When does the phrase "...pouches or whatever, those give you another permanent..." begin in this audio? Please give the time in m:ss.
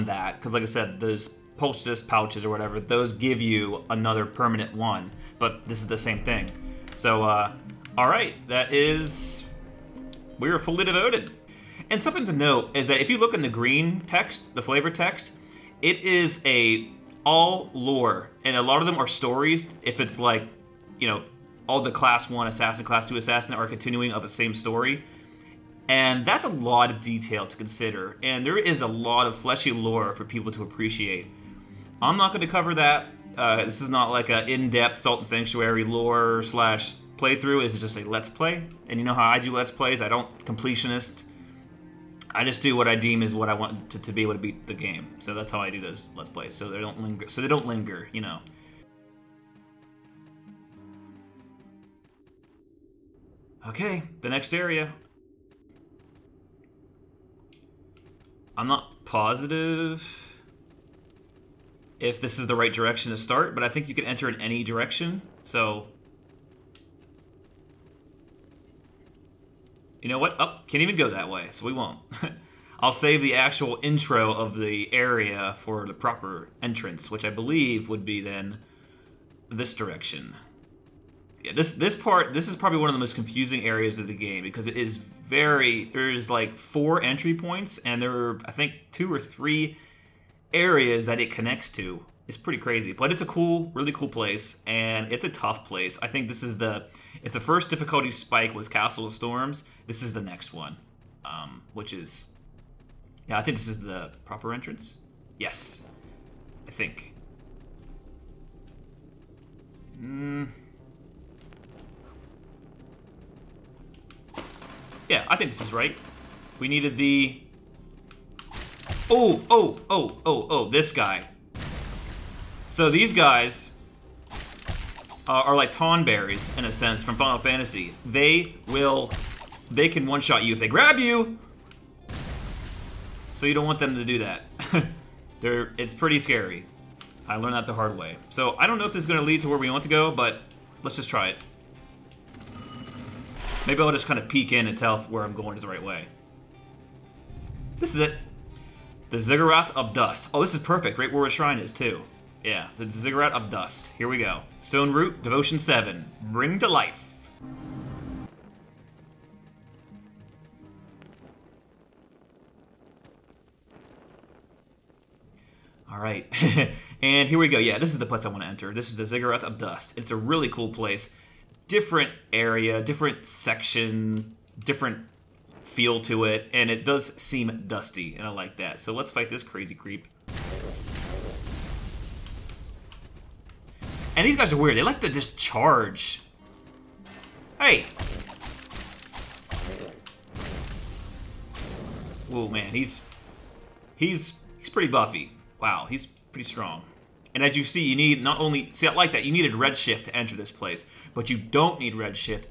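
0:02.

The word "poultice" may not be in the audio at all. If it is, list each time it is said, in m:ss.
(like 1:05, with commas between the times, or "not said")
0:01.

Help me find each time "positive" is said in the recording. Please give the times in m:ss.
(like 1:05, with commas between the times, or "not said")
0:59.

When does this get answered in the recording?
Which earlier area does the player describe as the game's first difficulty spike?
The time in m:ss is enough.
1:38.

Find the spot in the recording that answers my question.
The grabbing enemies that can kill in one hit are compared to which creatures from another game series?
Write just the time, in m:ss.
2:05.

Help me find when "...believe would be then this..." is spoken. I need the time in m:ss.
1:17.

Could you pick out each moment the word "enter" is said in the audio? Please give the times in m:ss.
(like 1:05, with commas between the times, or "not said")
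1:04, 2:48, 3:20.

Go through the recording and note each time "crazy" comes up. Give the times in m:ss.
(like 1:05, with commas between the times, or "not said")
1:32, 2:59.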